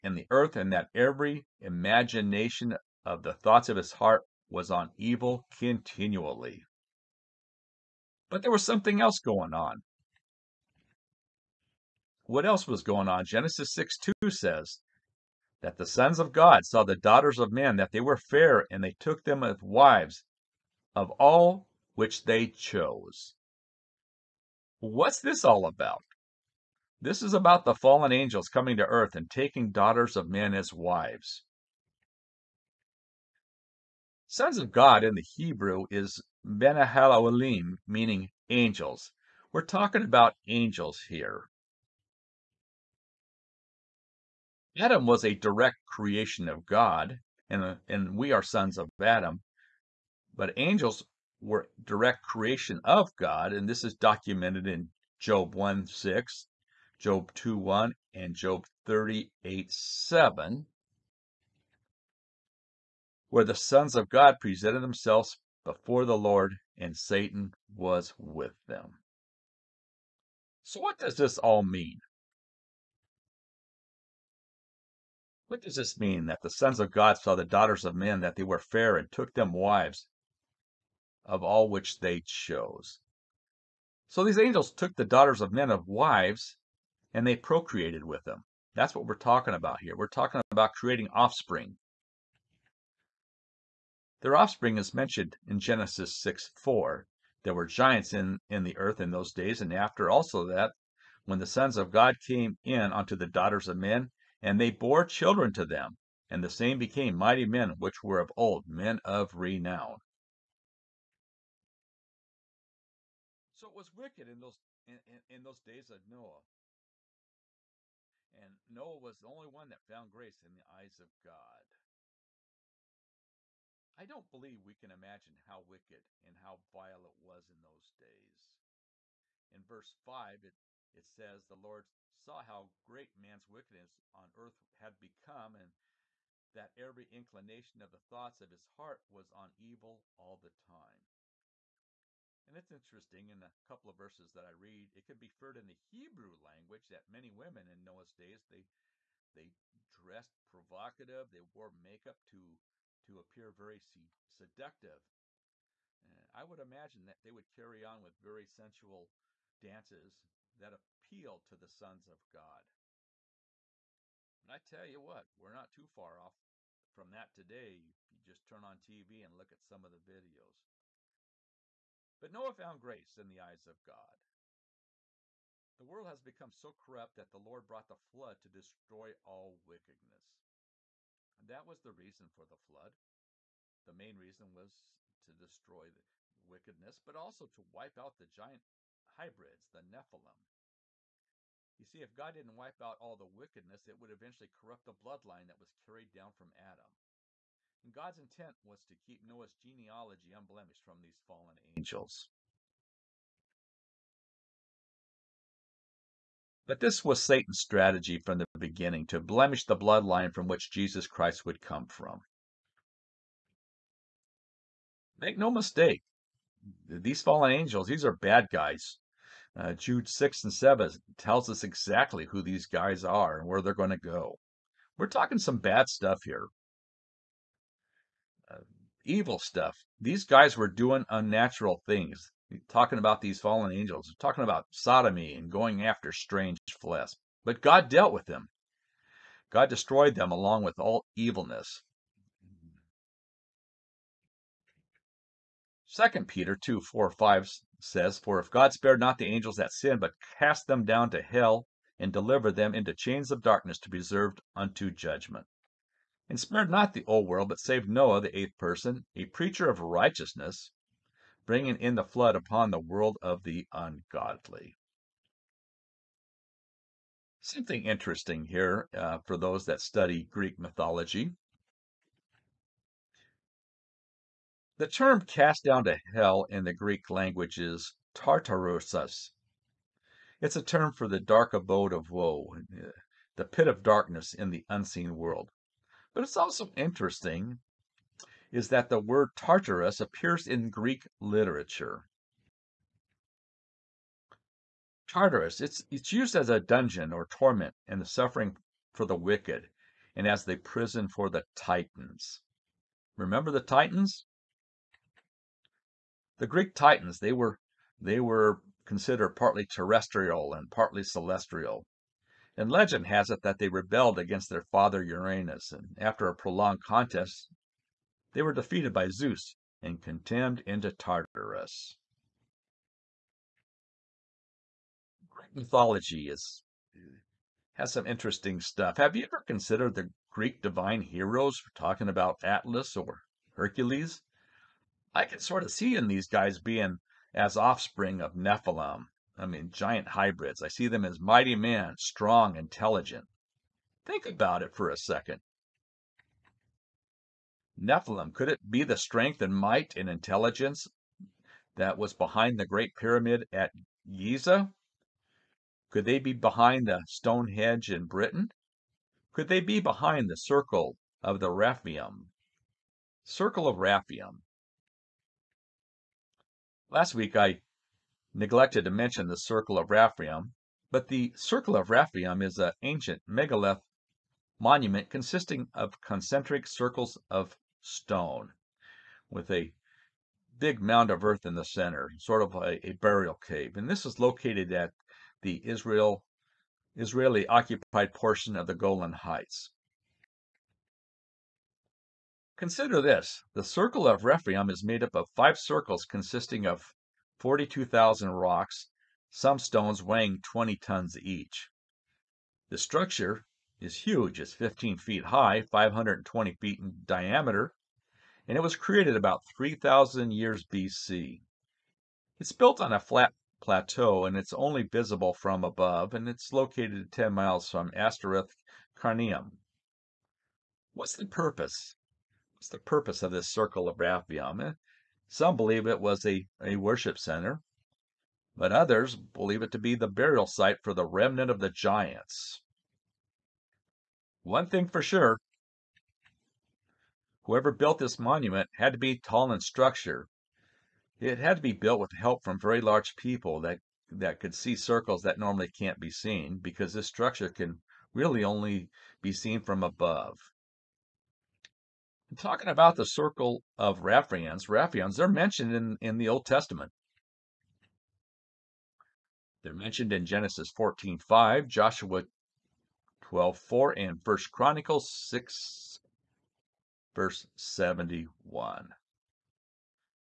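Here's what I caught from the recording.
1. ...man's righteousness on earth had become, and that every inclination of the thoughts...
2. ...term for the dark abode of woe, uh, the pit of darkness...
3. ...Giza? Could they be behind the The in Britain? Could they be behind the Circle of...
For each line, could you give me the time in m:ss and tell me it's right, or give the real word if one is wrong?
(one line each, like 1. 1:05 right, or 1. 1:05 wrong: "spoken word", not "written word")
1. 2:13 wrong: "wickedness", not "righteousness"
2. 4:40 right
3. 5:54 wrong: "Stonehenge", not "The".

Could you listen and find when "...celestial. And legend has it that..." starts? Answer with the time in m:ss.
5:11.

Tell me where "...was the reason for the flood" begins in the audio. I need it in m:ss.
3:01.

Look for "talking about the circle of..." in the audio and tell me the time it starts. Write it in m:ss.
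7:32.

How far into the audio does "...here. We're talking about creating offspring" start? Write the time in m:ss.
1:29.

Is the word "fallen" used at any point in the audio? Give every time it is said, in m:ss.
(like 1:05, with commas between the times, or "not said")
0:27, 3:21, 3:37, 3:53.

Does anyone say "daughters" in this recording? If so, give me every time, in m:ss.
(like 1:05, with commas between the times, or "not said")
0:16, 0:29, 1:17, 1:25, 1:43.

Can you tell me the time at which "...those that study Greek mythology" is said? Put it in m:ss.
4:29.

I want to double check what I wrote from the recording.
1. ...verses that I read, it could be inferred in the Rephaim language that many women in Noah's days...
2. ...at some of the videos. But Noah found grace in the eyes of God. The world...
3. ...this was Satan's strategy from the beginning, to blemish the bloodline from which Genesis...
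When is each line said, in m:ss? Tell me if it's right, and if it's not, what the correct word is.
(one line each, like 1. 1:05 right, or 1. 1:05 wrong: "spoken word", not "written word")
1. 2:23 wrong: "Hebrew", not "Rephaim"
2. 2:49 right
3. 3:26 wrong: "Jesus", not "Genesis".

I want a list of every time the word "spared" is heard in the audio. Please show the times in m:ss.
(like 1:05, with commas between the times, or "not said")
4:08, 4:16.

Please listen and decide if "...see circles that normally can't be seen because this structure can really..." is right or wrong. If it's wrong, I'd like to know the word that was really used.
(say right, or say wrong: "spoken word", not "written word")
right.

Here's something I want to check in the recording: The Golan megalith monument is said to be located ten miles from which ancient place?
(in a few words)
Ashteroth Karnaim.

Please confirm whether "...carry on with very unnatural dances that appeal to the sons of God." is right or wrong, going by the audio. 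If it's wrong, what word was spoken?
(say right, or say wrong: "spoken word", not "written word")
wrong: "sensual", not "unnatural".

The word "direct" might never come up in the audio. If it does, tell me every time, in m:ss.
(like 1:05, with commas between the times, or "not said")
0:45, 0:51.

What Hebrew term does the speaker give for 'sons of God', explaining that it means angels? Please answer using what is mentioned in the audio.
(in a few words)
Benahalalim.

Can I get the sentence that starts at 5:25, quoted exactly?
Greek mythology is has some interesting stuff.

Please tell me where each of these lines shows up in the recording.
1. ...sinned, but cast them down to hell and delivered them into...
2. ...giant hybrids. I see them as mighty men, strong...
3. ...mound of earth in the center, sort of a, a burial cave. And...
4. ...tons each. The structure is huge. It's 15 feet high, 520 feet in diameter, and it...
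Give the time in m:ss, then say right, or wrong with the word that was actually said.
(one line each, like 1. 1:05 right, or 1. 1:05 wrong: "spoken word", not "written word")
1. 4:09 right
2. 5:39 right
3. 6:20 right
4. 6:40 right.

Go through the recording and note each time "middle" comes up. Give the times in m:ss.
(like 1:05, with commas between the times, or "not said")
not said.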